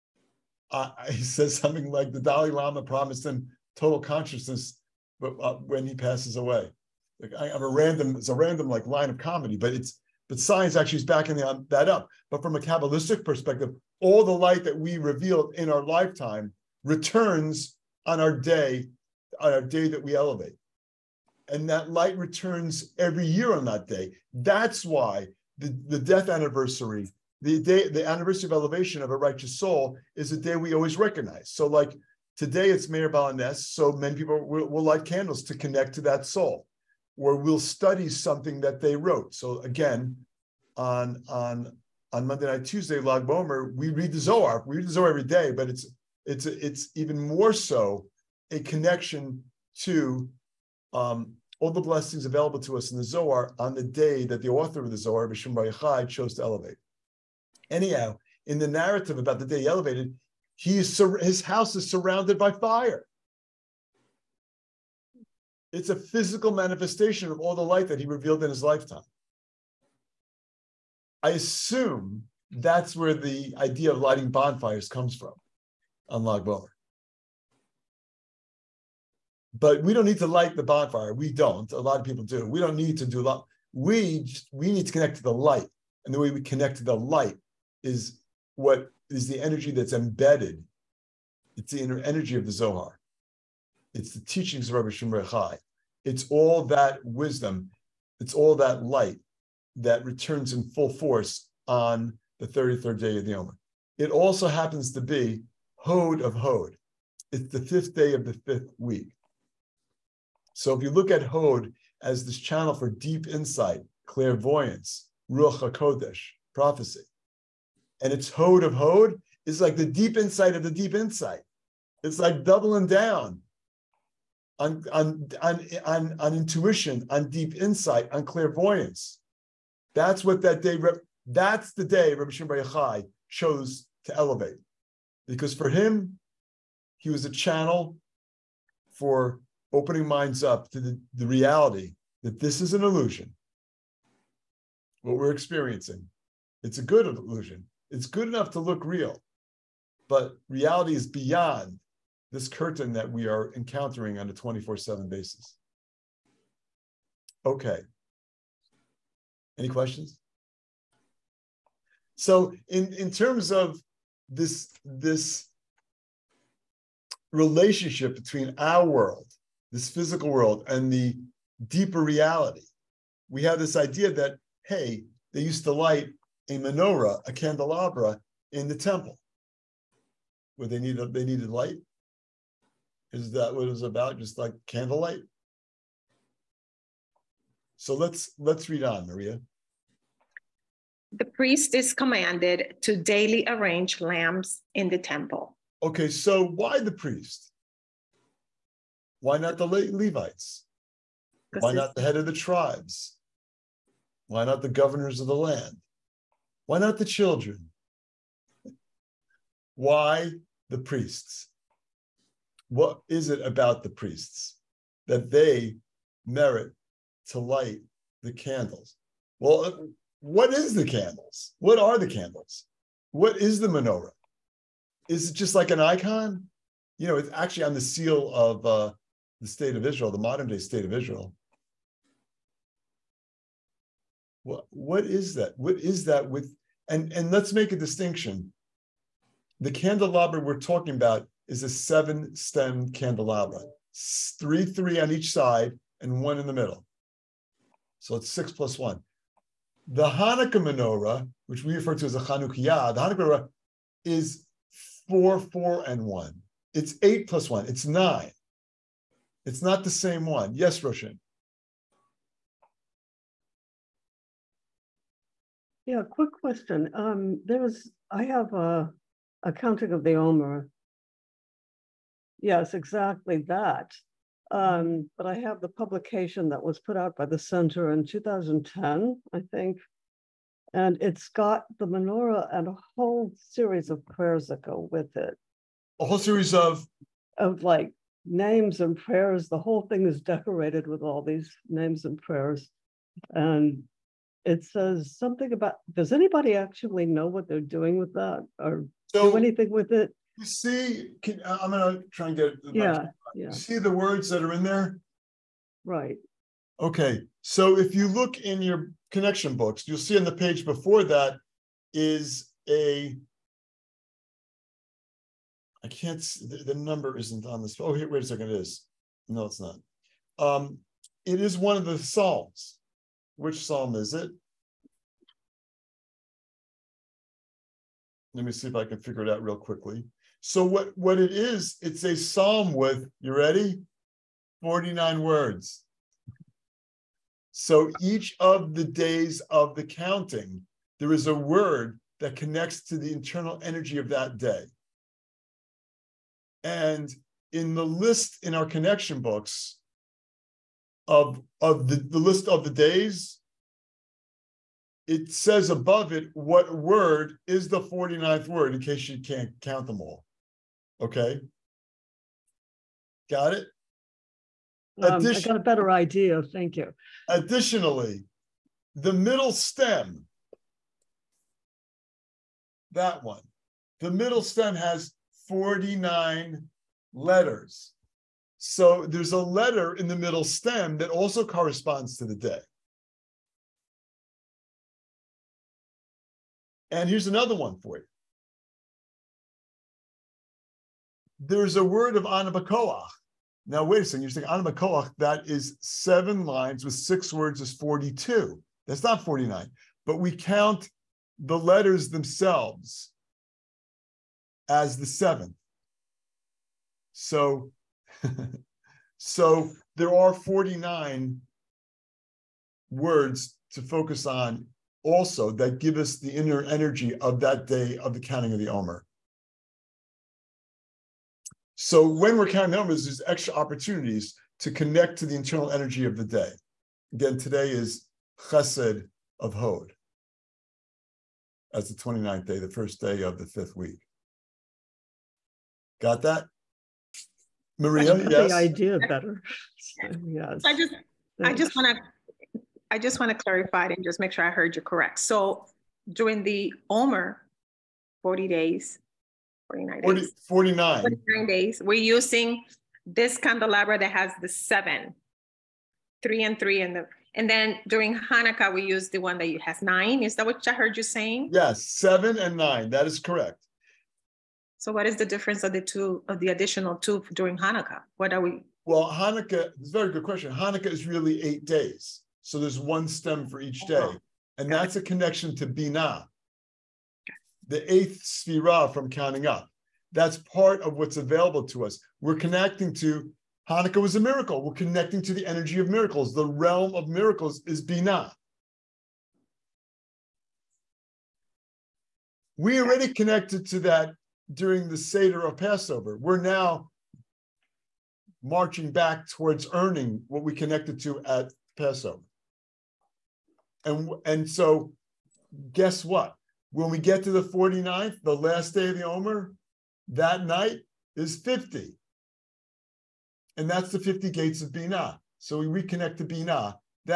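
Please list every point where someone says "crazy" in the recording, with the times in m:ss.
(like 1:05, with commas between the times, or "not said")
not said.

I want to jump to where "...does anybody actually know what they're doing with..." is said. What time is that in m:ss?
4:55.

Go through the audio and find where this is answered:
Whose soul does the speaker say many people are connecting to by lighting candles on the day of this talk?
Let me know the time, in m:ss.
0:32.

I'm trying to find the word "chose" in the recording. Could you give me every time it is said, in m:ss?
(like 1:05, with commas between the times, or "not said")
0:56, 2:13.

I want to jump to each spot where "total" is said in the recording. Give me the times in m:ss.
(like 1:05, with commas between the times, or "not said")
0:03.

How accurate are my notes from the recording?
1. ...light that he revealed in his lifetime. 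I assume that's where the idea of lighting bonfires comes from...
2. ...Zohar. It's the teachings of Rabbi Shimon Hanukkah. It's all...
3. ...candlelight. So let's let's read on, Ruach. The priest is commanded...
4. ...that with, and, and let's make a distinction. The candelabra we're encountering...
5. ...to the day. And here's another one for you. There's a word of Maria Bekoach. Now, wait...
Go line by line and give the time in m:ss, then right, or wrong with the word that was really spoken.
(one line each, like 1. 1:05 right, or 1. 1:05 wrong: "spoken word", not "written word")
1. 1:07 right
2. 1:32 wrong: "Chai", not "Hanukkah"
3. 3:04 wrong: "Maria", not "Ruach"
4. 3:56 wrong: "talking", not "encountering"
5. 6:22 wrong: "Ana", not "Maria".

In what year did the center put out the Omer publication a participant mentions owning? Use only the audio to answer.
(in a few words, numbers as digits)
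2010.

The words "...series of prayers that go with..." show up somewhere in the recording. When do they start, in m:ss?
4:43.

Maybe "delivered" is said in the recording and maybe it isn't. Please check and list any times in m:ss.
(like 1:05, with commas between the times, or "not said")
not said.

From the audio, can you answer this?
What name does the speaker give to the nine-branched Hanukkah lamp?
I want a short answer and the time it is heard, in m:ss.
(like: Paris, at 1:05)
Chanukiah, at 4:12.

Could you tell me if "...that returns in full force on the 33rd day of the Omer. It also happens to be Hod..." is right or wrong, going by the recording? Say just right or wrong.
right.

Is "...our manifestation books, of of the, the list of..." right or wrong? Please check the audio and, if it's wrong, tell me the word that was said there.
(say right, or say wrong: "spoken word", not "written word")
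wrong: "connection", not "manifestation".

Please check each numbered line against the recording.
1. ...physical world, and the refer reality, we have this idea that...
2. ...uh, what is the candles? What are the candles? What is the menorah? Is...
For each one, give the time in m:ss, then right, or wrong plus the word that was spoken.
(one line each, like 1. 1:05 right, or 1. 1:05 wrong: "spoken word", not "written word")
1. 2:49 wrong: "deeper", not "refer"
2. 3:39 right.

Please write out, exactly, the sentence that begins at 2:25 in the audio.
What we're experiencing, it's a good illusion.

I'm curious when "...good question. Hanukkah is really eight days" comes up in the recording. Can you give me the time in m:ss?
7:50.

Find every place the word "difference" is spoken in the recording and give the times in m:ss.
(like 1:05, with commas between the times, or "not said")
7:45.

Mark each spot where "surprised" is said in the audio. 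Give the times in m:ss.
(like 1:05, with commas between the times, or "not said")
not said.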